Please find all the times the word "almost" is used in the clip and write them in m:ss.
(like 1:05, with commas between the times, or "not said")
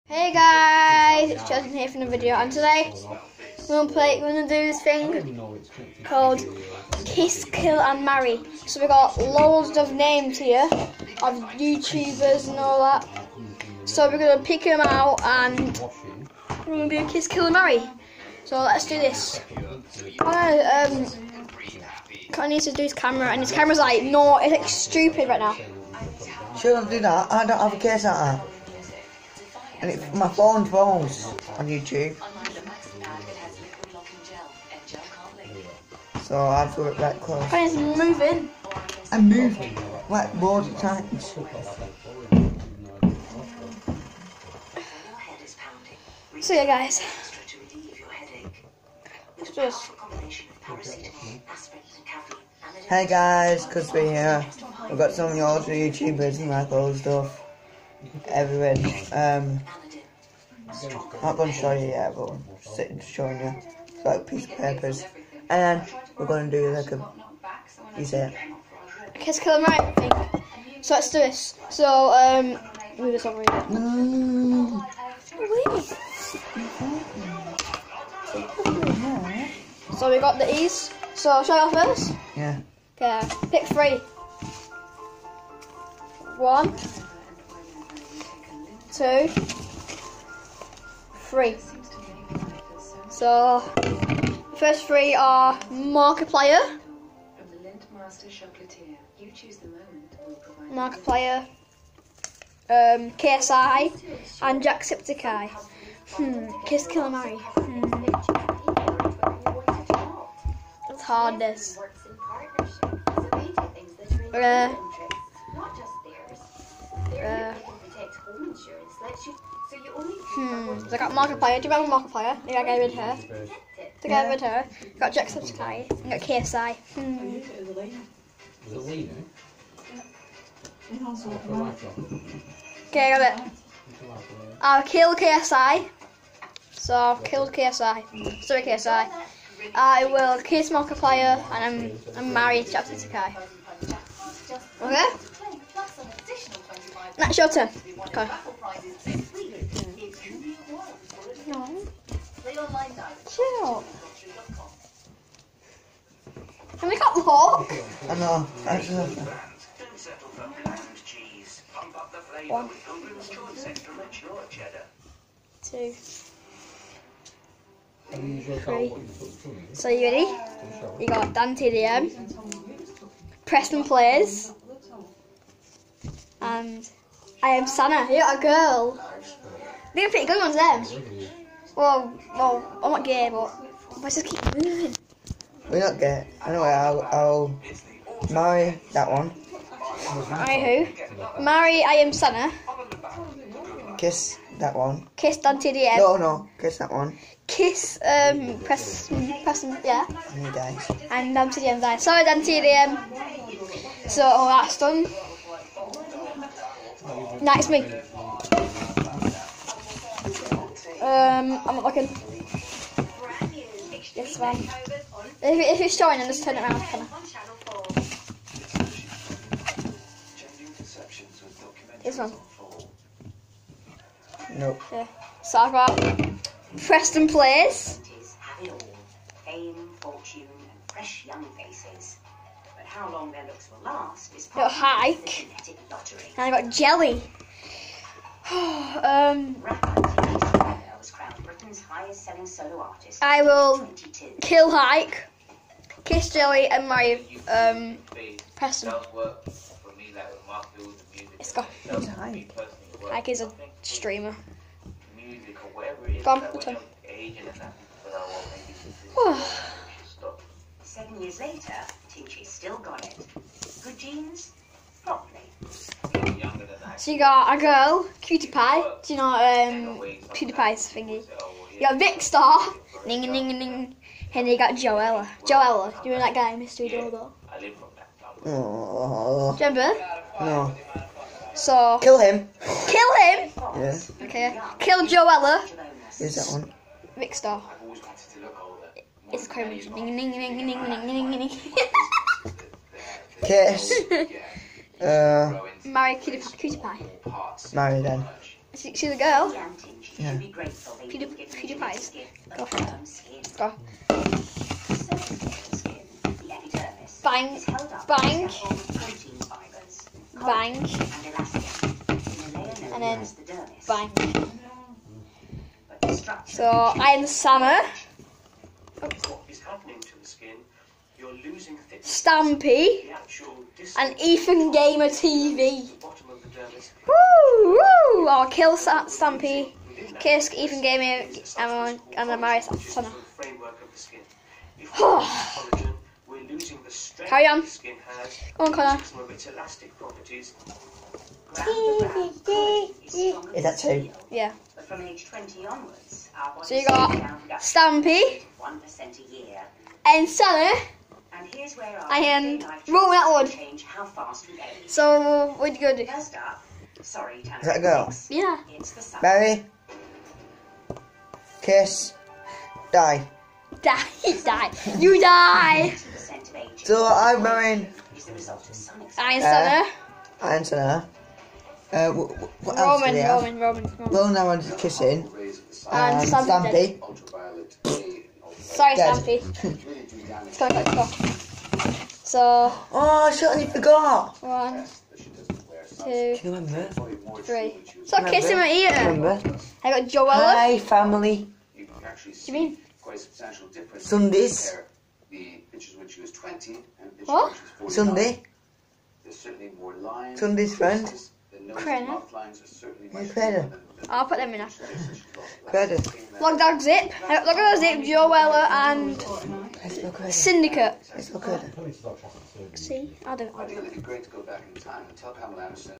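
not said.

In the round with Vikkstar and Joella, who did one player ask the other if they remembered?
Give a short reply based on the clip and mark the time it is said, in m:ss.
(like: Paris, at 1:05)
Mystery Doorbell, at 4:36.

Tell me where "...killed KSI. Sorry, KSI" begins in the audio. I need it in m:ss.
2:17.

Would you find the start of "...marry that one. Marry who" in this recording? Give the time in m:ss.
3:08.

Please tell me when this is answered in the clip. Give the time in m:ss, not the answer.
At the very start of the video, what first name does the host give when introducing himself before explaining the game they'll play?
0:01.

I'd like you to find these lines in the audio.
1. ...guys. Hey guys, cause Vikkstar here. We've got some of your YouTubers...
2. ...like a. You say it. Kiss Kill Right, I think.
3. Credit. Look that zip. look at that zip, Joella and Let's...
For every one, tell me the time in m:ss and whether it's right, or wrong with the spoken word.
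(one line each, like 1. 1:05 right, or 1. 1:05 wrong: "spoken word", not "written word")
1. 0:46 wrong: "Cusby", not "Vikkstar"
2. 1:06 right
3. 6:45 right.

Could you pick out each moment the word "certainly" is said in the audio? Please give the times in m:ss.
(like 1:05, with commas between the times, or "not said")
6:23, 6:39.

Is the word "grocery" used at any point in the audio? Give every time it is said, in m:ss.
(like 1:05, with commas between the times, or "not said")
not said.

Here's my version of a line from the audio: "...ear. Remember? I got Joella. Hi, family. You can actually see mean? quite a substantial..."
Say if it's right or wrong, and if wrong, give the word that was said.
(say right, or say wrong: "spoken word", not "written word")
right.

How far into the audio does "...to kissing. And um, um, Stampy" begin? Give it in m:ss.
6:14.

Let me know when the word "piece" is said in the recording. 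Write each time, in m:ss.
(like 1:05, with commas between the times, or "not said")
1:04.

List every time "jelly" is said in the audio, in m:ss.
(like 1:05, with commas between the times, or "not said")
3:56, 4:06.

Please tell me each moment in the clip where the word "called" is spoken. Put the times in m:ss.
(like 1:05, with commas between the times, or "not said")
0:06.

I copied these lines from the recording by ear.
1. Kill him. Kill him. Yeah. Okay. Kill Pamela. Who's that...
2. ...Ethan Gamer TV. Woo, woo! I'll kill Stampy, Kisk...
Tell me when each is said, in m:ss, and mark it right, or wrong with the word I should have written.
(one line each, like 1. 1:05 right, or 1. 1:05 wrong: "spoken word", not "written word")
1. 4:42 wrong: "Joella", not "Pamela"
2. 5:24 right.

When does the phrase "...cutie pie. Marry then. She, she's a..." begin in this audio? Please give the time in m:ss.
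4:56.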